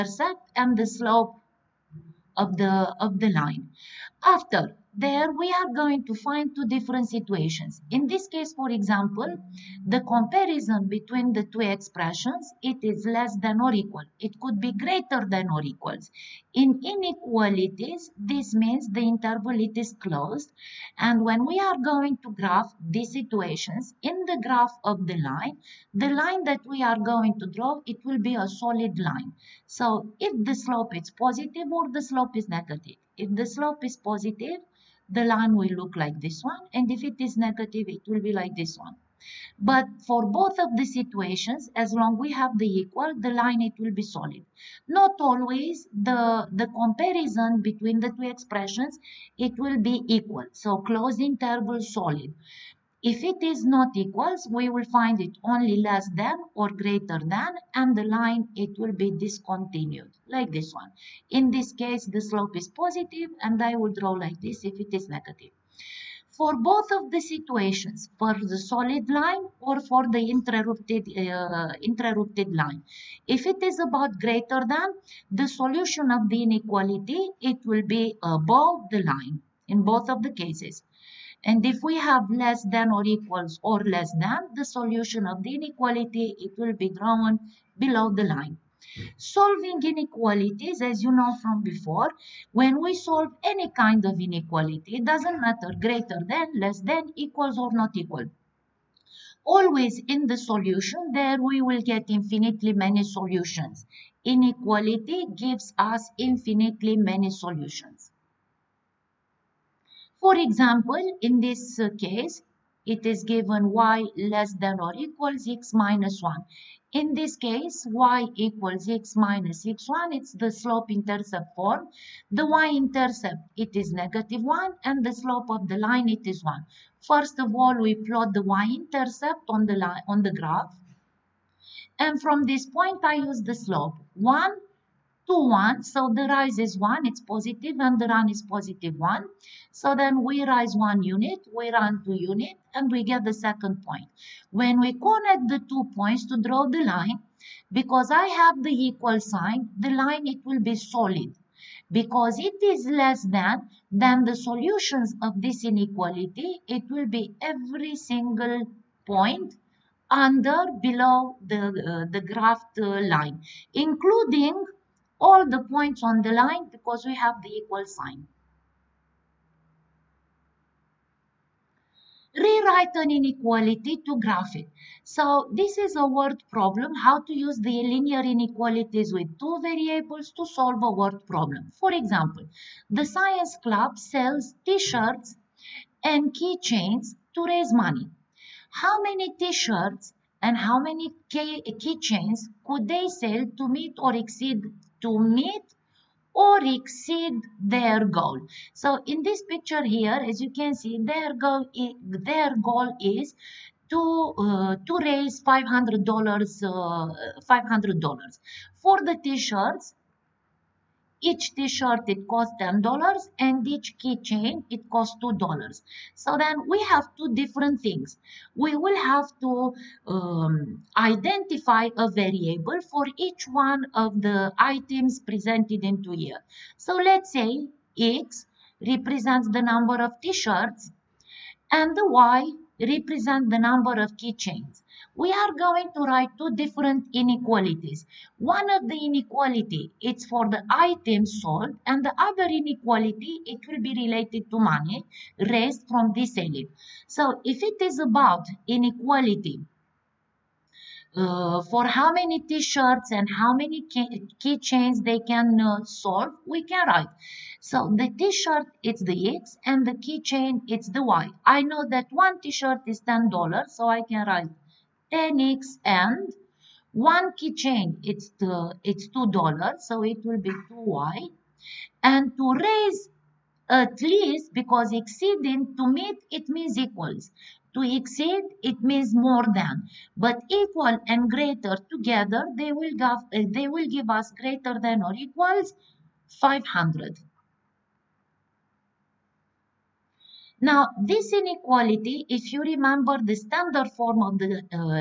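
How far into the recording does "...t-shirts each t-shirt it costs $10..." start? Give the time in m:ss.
3:29.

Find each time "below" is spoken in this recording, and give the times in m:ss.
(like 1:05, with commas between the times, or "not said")
1:27, 2:40.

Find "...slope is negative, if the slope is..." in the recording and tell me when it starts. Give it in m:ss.
0:32.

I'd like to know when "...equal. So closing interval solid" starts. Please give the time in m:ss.
0:50.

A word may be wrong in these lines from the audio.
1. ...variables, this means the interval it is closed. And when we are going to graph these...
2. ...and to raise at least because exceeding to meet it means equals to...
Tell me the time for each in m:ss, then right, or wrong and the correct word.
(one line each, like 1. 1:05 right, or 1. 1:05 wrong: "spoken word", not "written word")
1. 0:16 wrong: "inequalities", not "variables"
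2. 4:32 right.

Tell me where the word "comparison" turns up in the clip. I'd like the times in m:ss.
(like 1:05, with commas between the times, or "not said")
0:10, 0:46.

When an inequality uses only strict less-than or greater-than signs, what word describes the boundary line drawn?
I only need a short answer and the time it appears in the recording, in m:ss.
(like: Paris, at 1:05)
discontinued, at 0:59.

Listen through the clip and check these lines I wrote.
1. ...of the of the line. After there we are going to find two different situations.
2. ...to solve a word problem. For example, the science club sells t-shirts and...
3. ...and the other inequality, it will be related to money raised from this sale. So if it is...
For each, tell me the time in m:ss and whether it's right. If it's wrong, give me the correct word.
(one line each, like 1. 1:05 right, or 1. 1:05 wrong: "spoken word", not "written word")
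1. 0:02 right
2. 3:00 right
3. 4:01 right.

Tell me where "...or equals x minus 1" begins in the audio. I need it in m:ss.
1:54.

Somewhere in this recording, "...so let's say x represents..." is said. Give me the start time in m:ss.
3:46.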